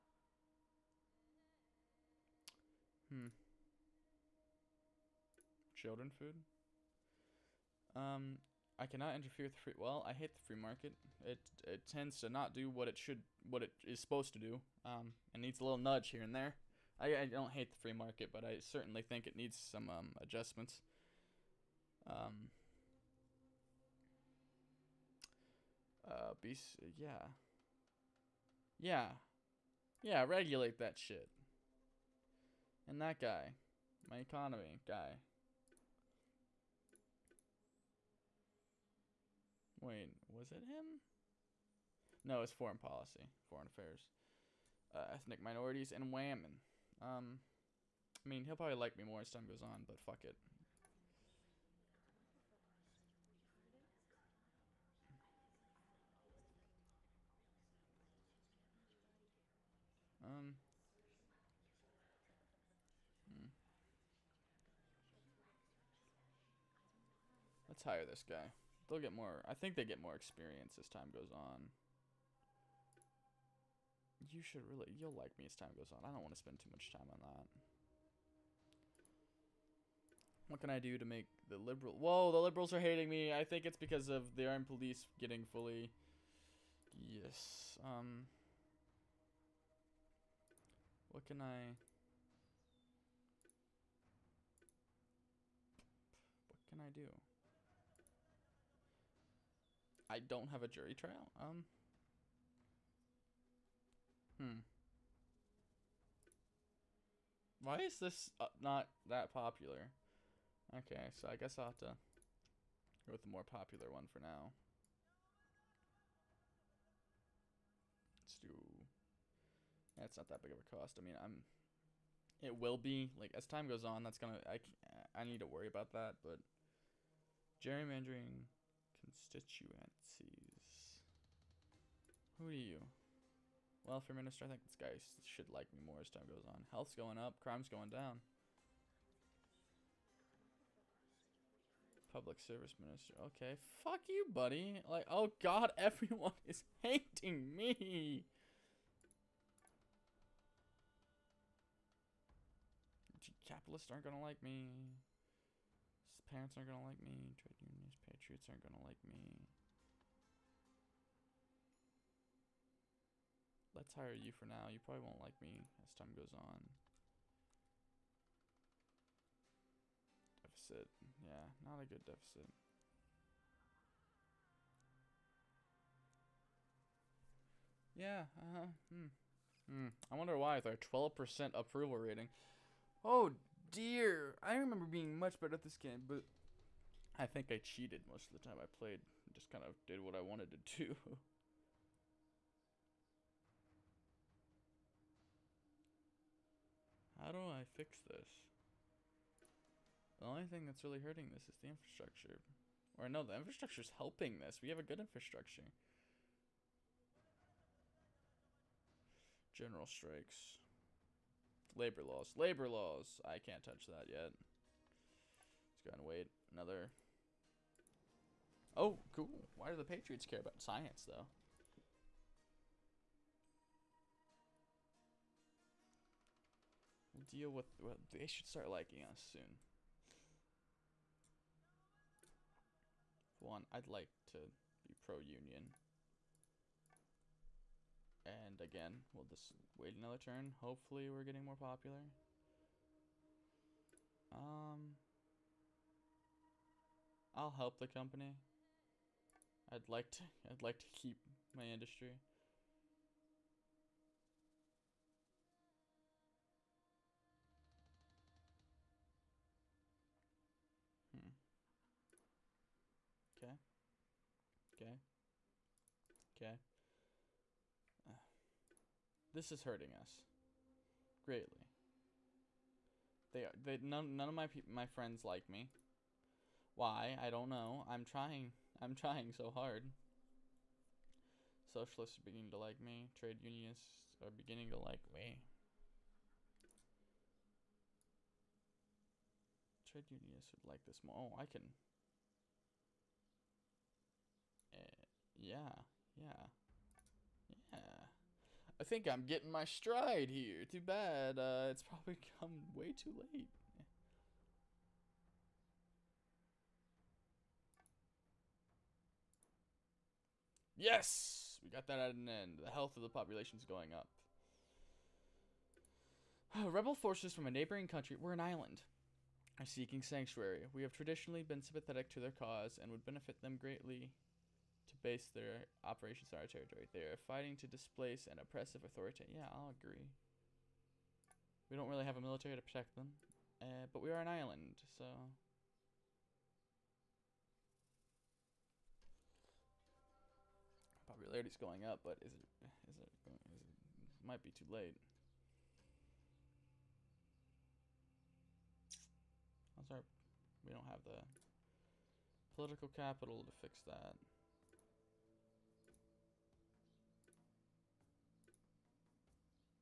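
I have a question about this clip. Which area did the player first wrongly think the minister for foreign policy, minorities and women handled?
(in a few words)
Economy.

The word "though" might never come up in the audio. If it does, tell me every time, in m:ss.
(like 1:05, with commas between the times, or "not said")
3:41.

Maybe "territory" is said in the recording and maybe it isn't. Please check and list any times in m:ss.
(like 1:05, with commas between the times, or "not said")
5:26.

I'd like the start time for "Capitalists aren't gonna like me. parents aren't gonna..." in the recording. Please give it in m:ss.
2:33.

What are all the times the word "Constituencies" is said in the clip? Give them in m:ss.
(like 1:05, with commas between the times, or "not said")
2:09.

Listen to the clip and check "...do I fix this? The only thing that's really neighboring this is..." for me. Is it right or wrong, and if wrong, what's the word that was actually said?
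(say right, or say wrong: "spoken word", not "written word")
wrong: "hurting", not "neighboring".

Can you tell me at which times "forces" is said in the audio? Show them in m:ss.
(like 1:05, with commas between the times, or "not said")
5:16.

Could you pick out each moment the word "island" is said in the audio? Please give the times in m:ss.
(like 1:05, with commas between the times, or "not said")
5:18, 5:34.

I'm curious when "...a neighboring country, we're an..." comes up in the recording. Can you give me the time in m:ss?
5:17.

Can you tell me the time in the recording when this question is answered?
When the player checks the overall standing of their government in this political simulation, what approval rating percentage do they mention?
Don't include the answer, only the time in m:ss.
3:00.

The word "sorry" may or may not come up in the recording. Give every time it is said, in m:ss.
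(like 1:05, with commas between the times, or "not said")
5:49.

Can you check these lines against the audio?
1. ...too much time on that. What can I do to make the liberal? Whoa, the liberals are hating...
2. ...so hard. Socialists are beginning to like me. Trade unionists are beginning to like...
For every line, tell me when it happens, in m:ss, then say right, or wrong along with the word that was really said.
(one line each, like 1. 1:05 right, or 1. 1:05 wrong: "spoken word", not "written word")
1. 1:16 right
2. 4:39 right.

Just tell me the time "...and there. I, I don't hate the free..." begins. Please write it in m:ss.
0:16.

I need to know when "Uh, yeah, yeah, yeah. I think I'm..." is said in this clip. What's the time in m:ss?
4:54.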